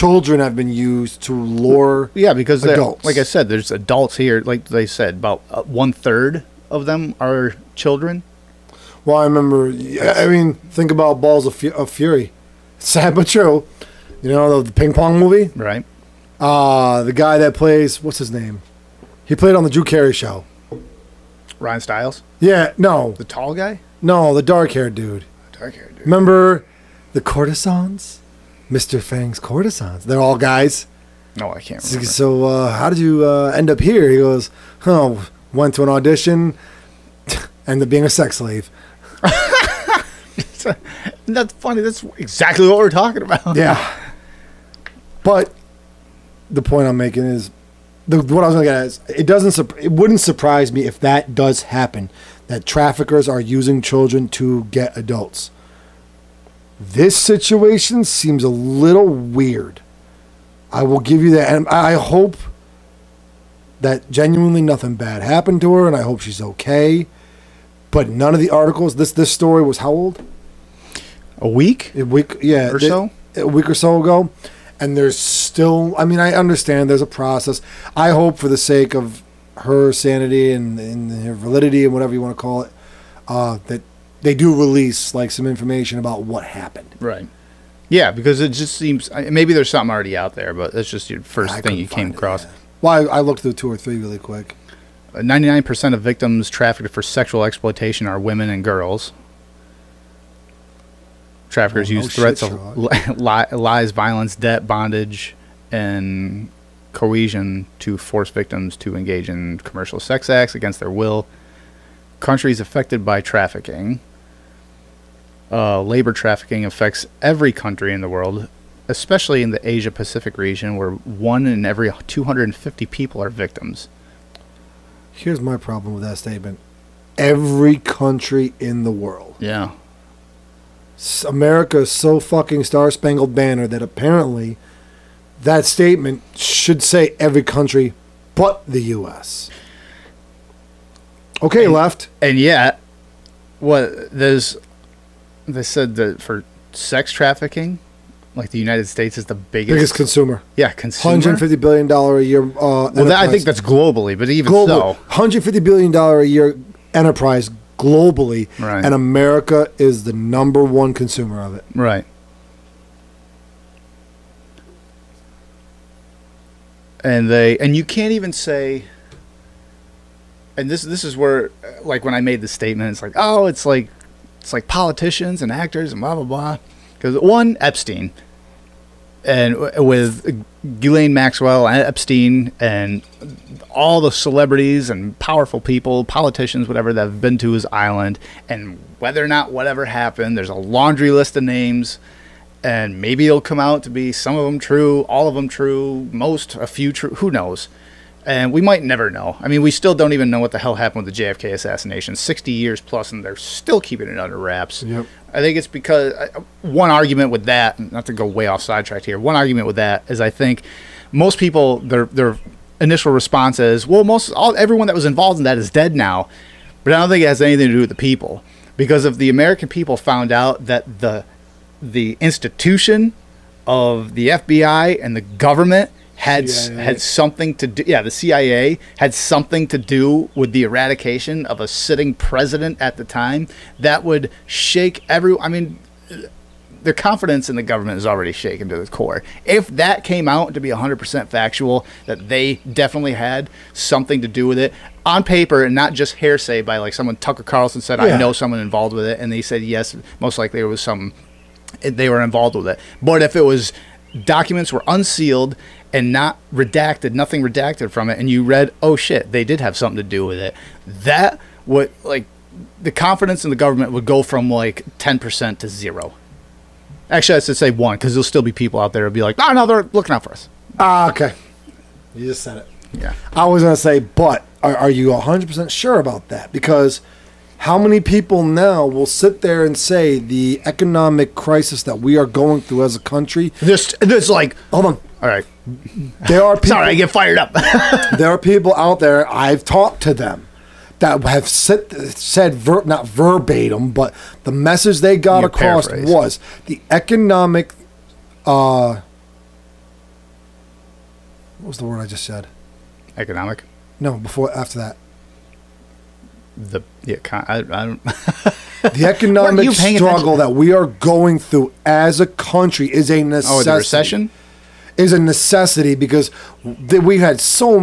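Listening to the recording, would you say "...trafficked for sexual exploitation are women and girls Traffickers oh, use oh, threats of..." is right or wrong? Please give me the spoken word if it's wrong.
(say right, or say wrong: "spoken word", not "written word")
right.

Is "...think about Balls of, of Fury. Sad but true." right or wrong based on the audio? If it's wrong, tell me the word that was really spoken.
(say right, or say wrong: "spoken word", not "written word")
right.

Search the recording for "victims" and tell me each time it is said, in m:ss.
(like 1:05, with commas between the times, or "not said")
1:36, 1:48, 2:03.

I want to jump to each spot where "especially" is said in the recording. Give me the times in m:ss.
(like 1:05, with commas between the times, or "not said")
1:58.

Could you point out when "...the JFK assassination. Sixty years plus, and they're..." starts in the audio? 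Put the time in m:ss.
3:21.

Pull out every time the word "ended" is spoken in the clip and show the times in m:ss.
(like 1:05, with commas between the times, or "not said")
0:37.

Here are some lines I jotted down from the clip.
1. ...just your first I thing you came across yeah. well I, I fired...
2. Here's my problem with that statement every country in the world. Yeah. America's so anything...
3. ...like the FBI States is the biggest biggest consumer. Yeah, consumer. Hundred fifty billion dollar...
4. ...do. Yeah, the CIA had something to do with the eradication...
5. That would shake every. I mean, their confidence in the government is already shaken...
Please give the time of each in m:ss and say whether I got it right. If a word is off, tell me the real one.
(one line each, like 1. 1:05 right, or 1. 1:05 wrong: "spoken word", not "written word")
1. 1:30 wrong: "looked", not "fired"
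2. 2:05 wrong: "fucking", not "anything"
3. 2:28 wrong: "United", not "FBI"
4. 3:47 right
5. 3:53 right.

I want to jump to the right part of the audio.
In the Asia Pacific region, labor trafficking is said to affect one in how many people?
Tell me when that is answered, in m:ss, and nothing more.
2:02.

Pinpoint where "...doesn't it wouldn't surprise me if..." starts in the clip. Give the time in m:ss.
0:49.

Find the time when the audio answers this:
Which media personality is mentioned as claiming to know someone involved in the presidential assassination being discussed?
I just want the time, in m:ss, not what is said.
4:07.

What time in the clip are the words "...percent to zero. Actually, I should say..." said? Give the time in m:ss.
4:25.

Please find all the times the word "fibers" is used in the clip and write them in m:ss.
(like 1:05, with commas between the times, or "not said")
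not said.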